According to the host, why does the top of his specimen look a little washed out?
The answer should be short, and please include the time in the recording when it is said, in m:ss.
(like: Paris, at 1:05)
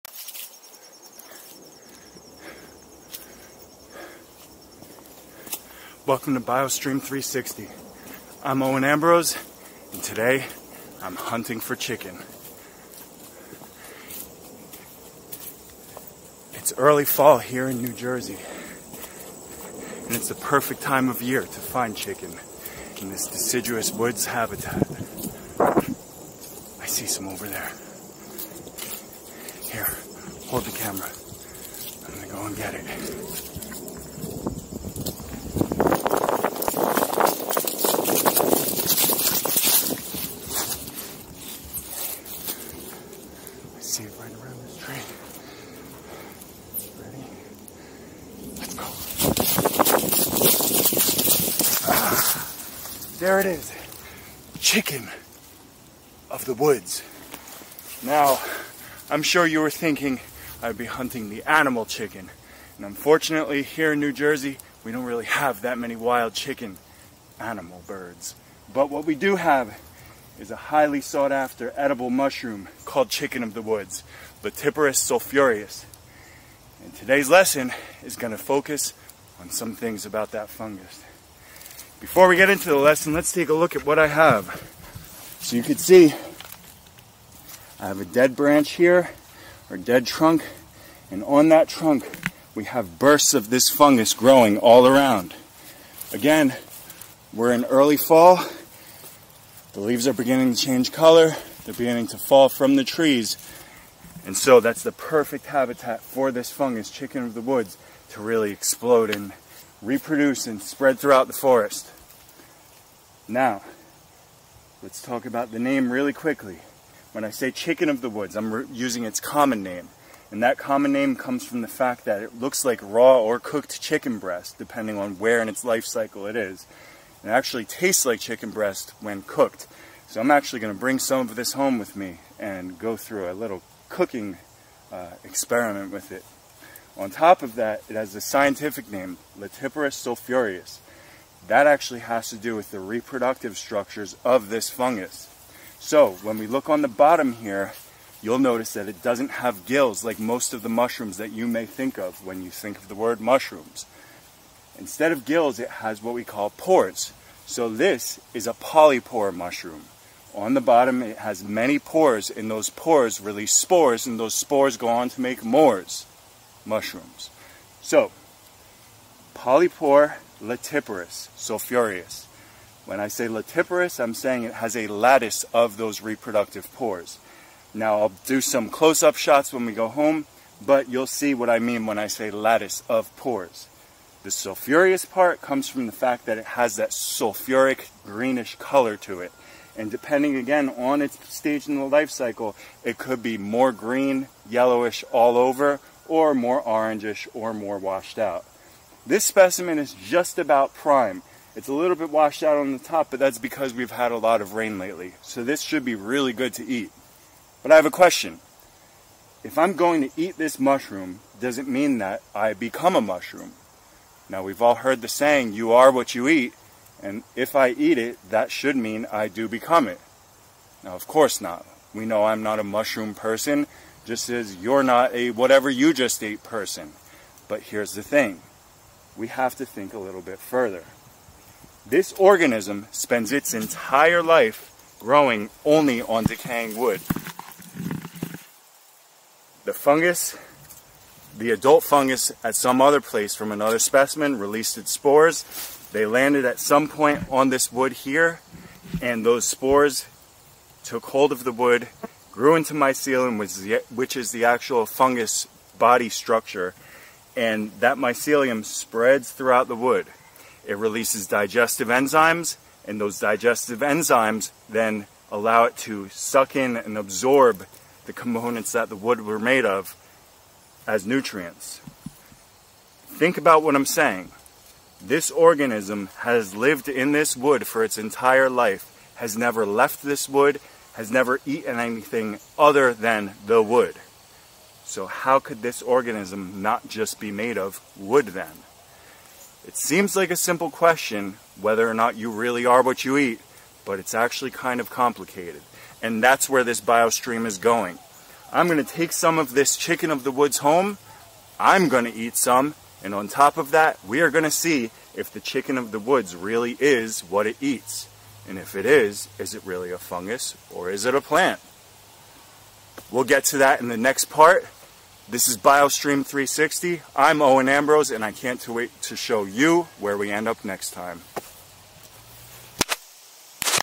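a lot of rain, at 3:24.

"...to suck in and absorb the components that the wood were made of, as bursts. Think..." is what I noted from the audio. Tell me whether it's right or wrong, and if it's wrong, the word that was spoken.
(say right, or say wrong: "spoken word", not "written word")
wrong: "nutrients", not "bursts".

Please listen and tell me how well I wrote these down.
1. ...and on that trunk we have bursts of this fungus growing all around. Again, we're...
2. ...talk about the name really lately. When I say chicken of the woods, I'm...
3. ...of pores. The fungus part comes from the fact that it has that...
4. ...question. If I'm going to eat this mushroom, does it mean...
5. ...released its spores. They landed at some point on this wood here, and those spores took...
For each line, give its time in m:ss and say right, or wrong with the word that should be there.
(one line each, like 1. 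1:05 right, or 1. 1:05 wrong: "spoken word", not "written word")
1. 1:31 right
2. 1:55 wrong: "quickly", not "lately"
3. 3:02 wrong: "sulfurous", not "fungus"
4. 3:27 right
5. 4:04 right.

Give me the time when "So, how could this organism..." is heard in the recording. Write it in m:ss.
4:44.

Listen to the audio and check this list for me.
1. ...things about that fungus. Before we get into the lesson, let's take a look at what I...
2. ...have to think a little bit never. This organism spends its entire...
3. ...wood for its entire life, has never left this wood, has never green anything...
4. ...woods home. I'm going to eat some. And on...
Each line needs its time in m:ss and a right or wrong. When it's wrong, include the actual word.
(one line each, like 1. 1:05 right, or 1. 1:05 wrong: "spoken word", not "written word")
1. 1:19 right
2. 3:49 wrong: "further", not "never"
3. 4:37 wrong: "eaten", not "green"
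4. 5:00 right.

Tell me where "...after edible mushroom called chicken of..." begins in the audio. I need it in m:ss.
1:11.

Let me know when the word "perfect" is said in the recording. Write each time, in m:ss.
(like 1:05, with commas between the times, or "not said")
0:20, 1:44.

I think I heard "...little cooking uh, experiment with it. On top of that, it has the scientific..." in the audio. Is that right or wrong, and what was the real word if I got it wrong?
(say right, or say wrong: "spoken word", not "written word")
right.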